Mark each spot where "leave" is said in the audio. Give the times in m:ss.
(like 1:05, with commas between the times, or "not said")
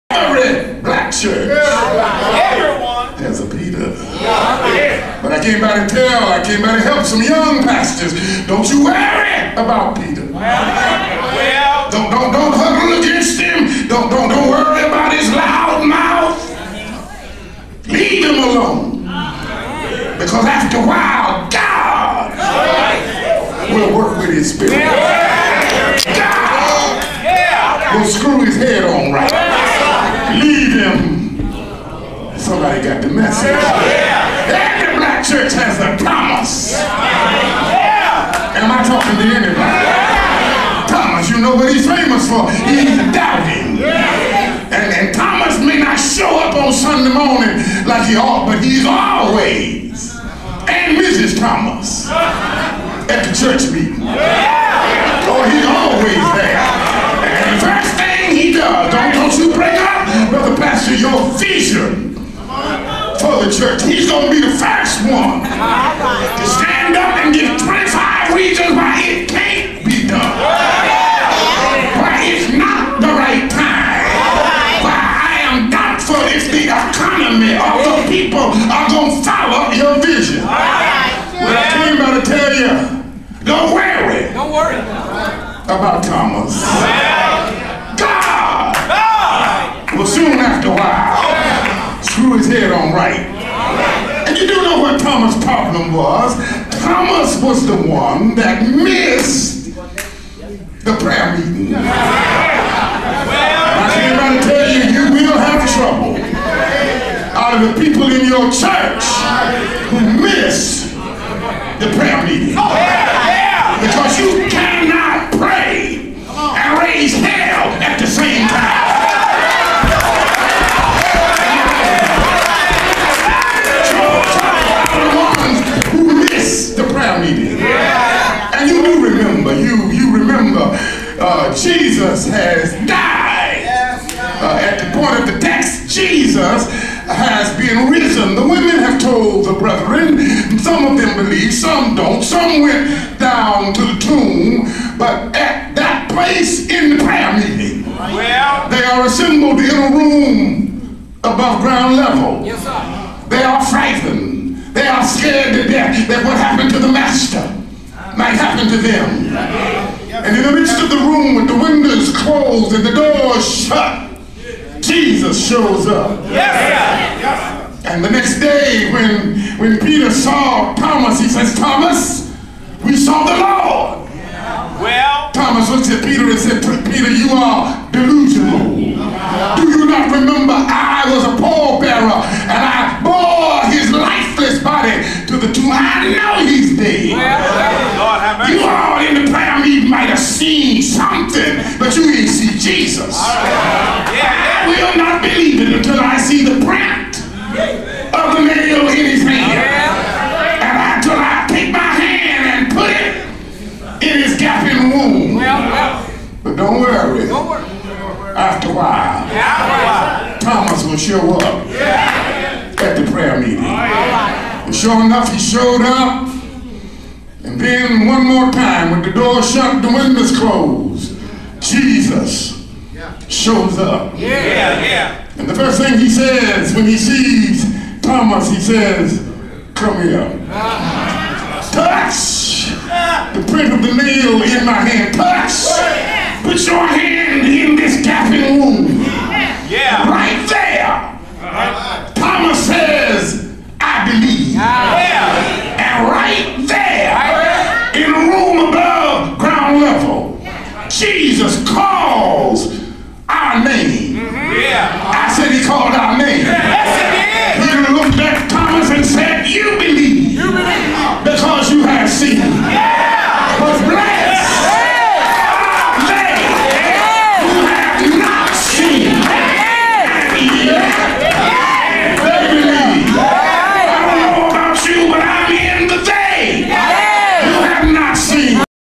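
0:17, 0:30.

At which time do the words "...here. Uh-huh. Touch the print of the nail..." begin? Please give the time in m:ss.
3:50.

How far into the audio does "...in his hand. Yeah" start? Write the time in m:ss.
3:18.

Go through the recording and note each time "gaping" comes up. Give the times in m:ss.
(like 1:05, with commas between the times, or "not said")
3:24, 3:58.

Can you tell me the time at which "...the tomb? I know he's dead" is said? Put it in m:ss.
3:05.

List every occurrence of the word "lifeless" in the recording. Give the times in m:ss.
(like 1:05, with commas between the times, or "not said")
3:03.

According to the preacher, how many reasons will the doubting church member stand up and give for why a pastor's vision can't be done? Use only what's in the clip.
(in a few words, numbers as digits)
25.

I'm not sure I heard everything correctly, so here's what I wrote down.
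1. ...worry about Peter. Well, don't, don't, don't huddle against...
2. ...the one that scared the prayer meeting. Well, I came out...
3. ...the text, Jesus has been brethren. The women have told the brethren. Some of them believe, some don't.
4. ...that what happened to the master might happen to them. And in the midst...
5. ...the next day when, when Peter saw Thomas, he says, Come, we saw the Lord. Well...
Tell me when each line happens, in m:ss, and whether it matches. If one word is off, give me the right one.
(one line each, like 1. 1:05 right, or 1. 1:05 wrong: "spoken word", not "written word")
1. 0:08 right
2. 1:37 wrong: "missed", not "scared"
3. 2:15 wrong: "risen", not "brethren"
4. 2:36 right
5. 2:48 wrong: "Thomas", not "Come".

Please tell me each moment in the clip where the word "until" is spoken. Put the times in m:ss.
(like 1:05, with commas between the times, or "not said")
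3:15, 3:20.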